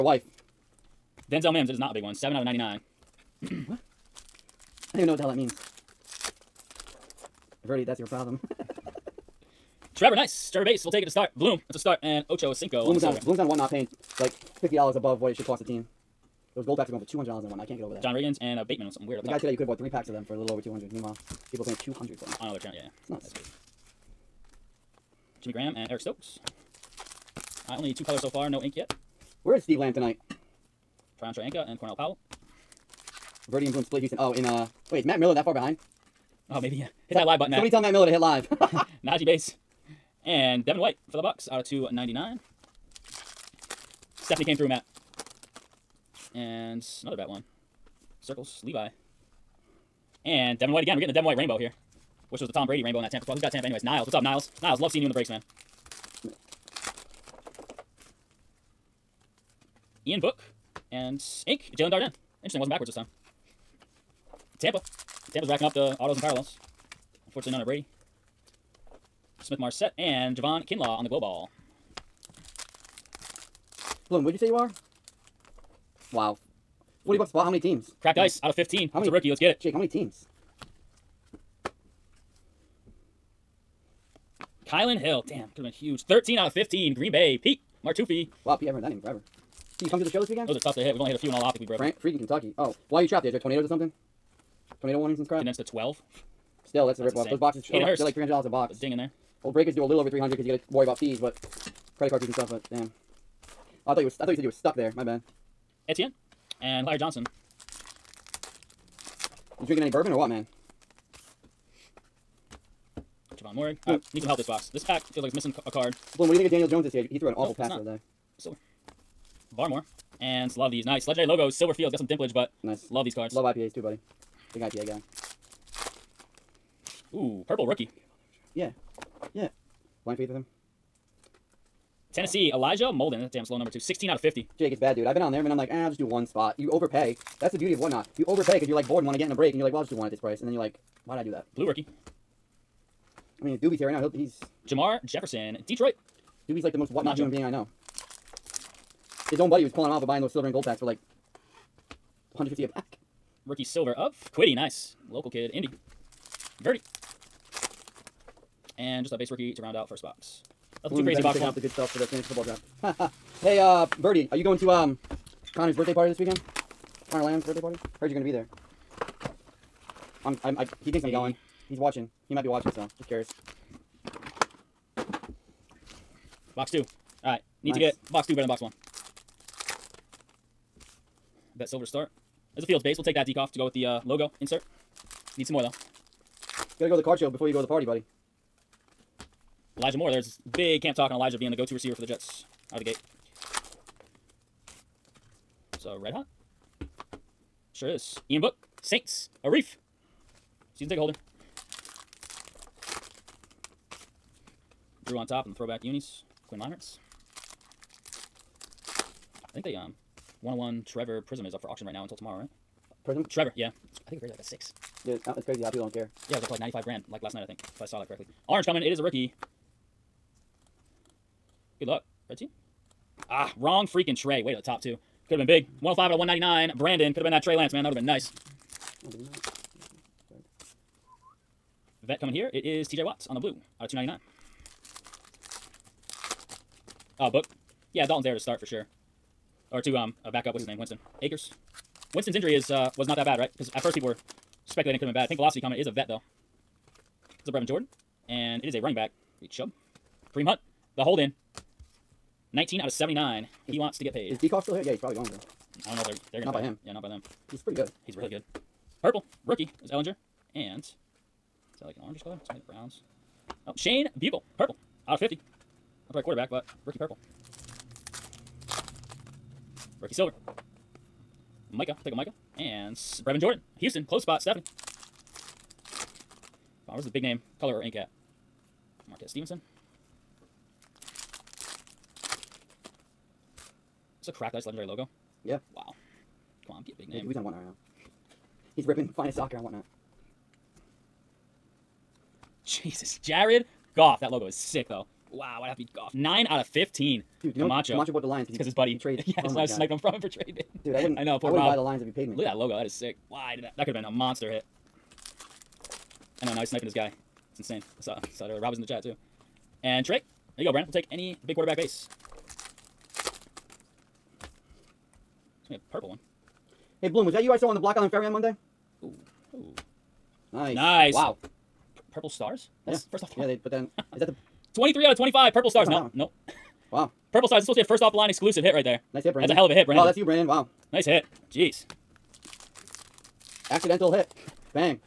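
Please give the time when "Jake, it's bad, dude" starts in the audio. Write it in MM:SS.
02:14.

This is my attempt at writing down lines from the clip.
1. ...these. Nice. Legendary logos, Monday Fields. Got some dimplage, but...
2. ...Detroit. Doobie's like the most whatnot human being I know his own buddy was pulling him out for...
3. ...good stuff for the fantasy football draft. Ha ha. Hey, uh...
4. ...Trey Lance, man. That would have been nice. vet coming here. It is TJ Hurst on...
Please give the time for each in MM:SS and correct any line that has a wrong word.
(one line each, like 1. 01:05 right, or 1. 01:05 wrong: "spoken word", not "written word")
1. 02:00 wrong: "Silver", not "Monday"
2. 02:25 right
3. 02:41 right
4. 03:47 wrong: "Watts", not "Hurst".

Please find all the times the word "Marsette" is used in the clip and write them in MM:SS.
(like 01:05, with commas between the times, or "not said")
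01:09.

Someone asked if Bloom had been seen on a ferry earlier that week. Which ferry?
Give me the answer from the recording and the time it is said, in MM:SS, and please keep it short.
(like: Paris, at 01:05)
Block Island Ferry, at 05:17.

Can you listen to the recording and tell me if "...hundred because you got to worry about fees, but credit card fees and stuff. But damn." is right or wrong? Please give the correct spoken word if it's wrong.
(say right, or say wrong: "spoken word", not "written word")
right.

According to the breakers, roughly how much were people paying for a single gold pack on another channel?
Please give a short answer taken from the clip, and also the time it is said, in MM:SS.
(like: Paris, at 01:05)
$200, at 00:17.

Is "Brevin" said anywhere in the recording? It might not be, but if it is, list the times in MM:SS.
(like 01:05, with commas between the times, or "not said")
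04:07, 04:32.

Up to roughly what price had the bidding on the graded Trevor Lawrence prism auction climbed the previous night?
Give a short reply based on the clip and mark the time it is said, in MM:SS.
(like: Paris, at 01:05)
95 grand, at 03:36.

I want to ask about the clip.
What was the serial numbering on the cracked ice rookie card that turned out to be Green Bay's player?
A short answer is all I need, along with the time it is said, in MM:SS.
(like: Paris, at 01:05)
13 out of 15, at 01:26.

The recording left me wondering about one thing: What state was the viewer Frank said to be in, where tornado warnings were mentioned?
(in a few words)
Kentucky.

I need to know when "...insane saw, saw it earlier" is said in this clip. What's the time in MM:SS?
05:07.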